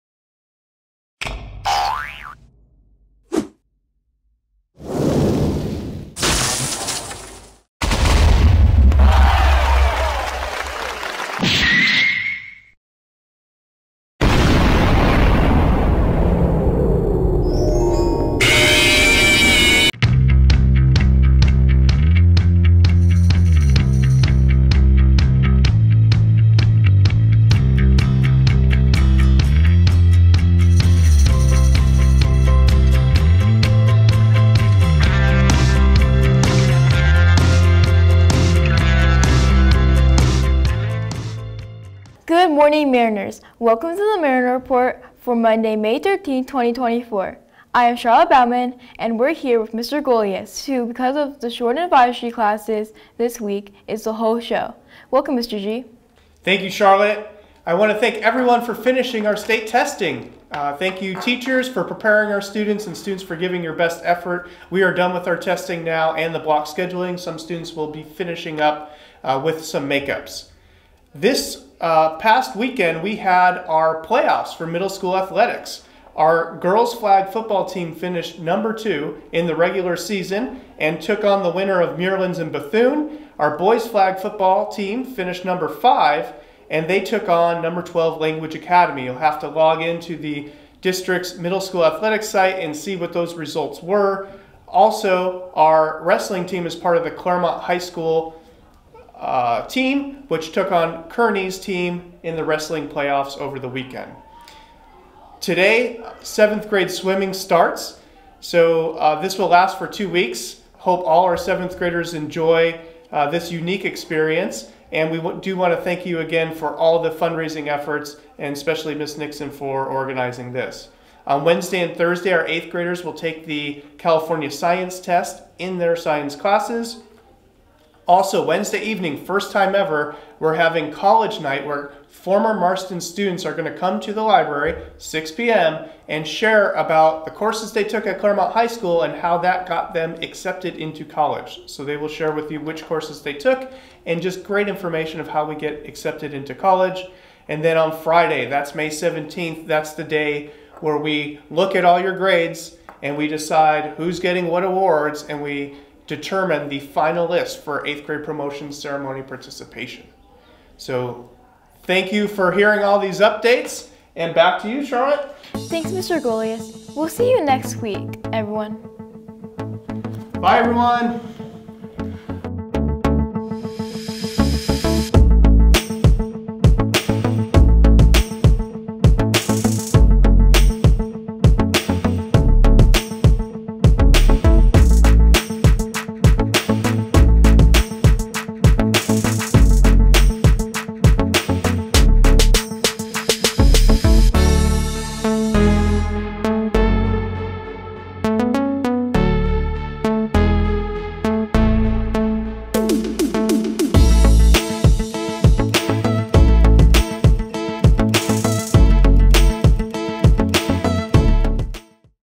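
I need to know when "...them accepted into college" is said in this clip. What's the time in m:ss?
2:19.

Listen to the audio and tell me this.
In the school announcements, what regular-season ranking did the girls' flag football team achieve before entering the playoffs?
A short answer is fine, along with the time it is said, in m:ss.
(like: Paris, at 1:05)
Number 2, at 1:18.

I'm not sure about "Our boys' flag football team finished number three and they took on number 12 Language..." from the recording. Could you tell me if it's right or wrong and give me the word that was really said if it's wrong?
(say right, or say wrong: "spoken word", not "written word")
wrong: "five", not "three".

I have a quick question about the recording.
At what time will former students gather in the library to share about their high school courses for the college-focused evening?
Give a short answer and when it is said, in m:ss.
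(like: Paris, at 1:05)
6 p.m., at 2:14.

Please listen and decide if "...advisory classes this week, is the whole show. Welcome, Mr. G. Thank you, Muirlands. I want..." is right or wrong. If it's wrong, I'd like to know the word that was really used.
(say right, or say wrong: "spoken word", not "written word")
wrong: "Charlotte", not "Muirlands".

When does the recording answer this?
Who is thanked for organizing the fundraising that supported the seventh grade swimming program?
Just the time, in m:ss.
1:58.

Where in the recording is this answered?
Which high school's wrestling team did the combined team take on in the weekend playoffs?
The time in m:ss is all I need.
1:41.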